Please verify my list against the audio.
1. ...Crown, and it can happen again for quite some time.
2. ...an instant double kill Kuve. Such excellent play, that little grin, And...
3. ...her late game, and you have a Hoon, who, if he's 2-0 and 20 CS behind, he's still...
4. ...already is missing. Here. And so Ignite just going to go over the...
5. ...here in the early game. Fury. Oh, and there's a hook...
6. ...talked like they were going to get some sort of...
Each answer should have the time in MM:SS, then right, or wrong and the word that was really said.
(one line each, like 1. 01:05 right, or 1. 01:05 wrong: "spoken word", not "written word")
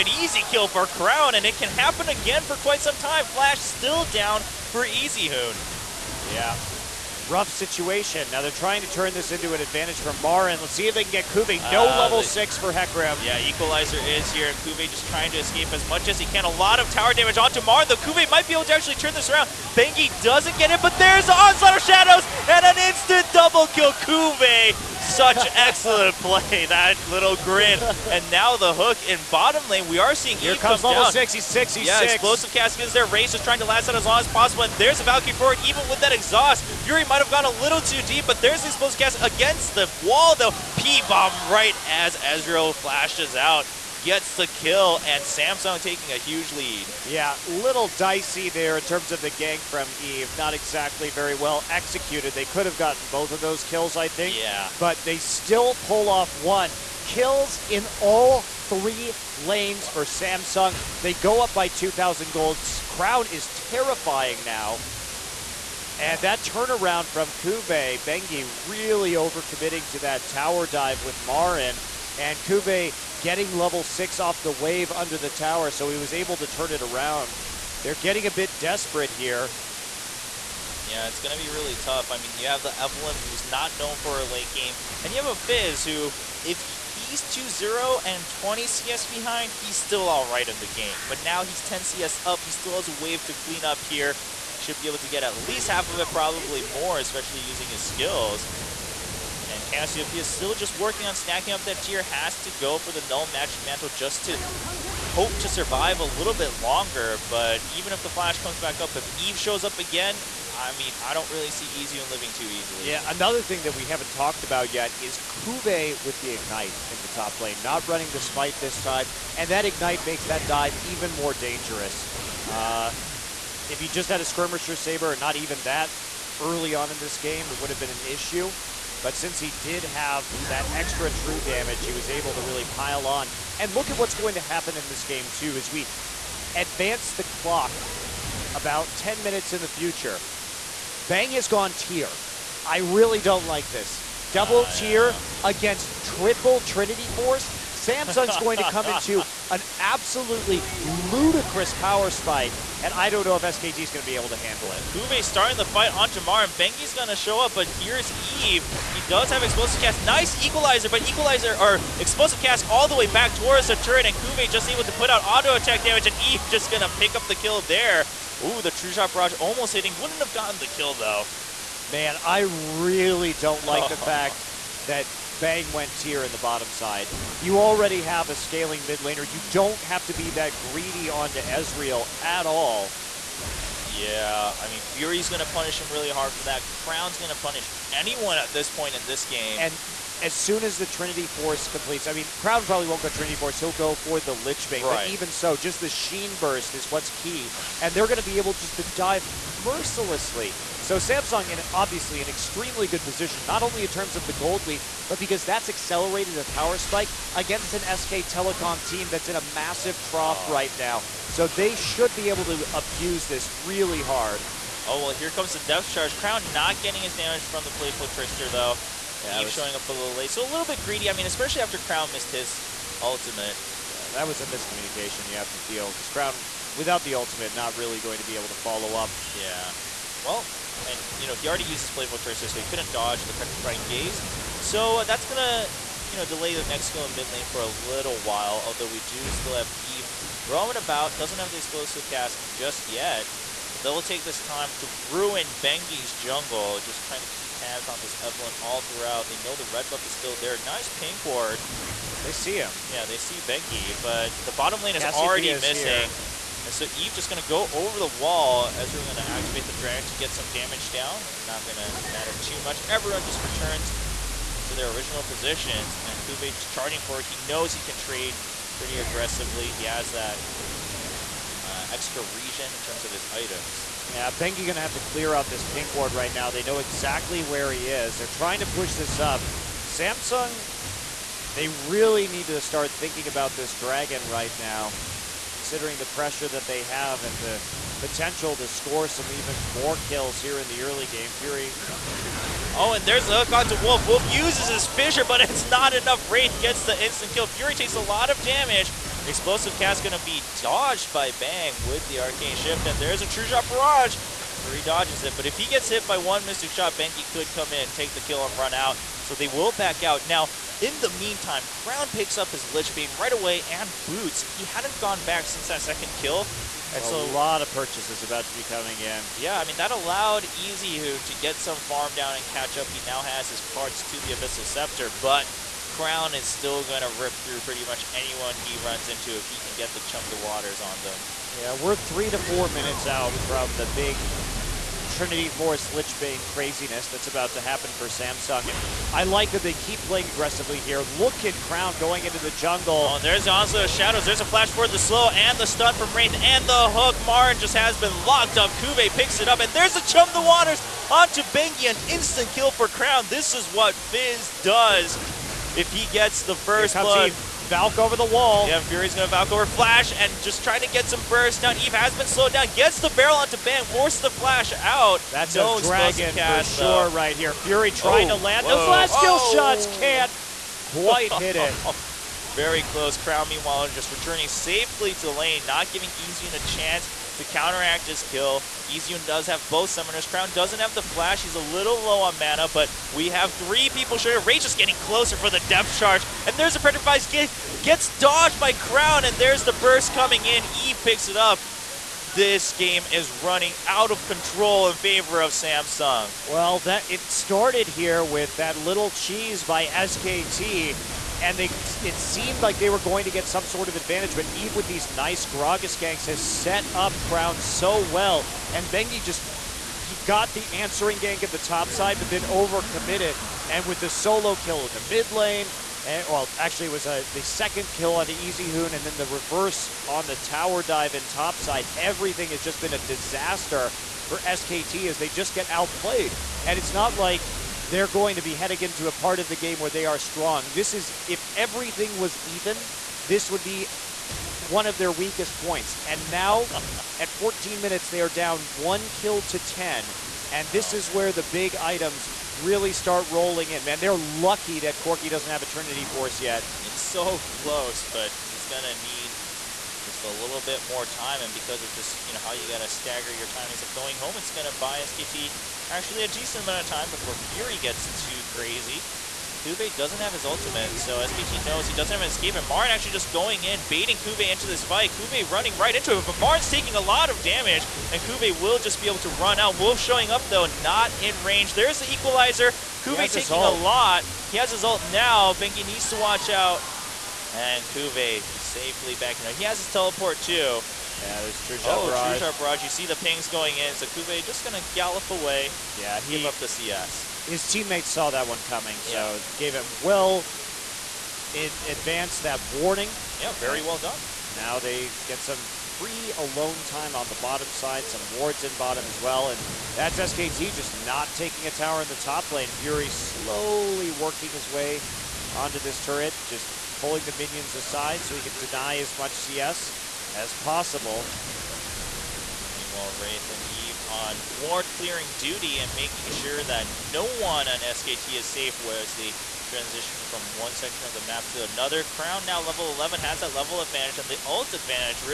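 1. 00:00 right
2. 00:22 right
3. 01:24 wrong: "Fizz", not "Hoon"
4. 04:15 wrong: "Eve", not "Ignite"
5. 04:50 right
6. 06:42 wrong: "seemed", not "talked".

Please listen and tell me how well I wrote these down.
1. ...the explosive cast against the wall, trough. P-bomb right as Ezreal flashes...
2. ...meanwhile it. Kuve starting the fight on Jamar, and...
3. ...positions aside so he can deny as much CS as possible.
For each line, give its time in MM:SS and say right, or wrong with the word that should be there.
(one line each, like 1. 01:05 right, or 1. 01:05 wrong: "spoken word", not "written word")
1. 00:38 wrong: "though", not "trough"
2. 02:34 wrong: "handle", not "meanwhile"
3. 08:27 wrong: "minions", not "positions".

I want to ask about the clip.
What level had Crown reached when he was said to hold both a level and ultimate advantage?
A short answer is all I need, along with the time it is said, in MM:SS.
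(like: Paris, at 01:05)
11, at 08:42.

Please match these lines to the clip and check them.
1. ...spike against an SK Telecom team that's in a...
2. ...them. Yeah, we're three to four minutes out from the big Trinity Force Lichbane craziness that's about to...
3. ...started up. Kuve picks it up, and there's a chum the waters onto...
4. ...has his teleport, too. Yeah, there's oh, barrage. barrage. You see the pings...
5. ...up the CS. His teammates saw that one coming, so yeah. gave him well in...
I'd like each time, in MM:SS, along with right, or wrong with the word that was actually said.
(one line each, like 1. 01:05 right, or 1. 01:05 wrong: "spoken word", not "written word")
1. 03:26 right
2. 05:31 right
3. 05:48 wrong: "locked", not "started"
4. 07:59 right
5. 08:06 right.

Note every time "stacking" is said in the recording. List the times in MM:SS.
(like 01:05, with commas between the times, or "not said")
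01:41.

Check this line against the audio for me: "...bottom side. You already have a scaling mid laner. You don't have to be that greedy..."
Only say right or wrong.
right.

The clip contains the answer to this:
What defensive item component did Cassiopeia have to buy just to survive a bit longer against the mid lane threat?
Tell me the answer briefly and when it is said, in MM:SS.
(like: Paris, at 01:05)
Null Magic Mantle, at 01:43.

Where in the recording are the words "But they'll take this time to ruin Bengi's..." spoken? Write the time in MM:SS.
04:03.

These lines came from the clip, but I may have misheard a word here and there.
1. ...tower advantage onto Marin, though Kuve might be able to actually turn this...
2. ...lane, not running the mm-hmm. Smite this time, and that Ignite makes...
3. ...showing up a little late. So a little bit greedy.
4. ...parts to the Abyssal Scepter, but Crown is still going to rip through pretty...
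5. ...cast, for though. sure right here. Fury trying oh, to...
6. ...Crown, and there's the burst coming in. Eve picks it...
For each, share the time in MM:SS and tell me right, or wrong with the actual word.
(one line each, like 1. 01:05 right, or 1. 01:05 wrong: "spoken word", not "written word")
1. 00:16 wrong: "damage", not "advantage"
2. 01:57 right
3. 03:39 right
4. 05:23 right
5. 06:06 right
6. 06:28 right.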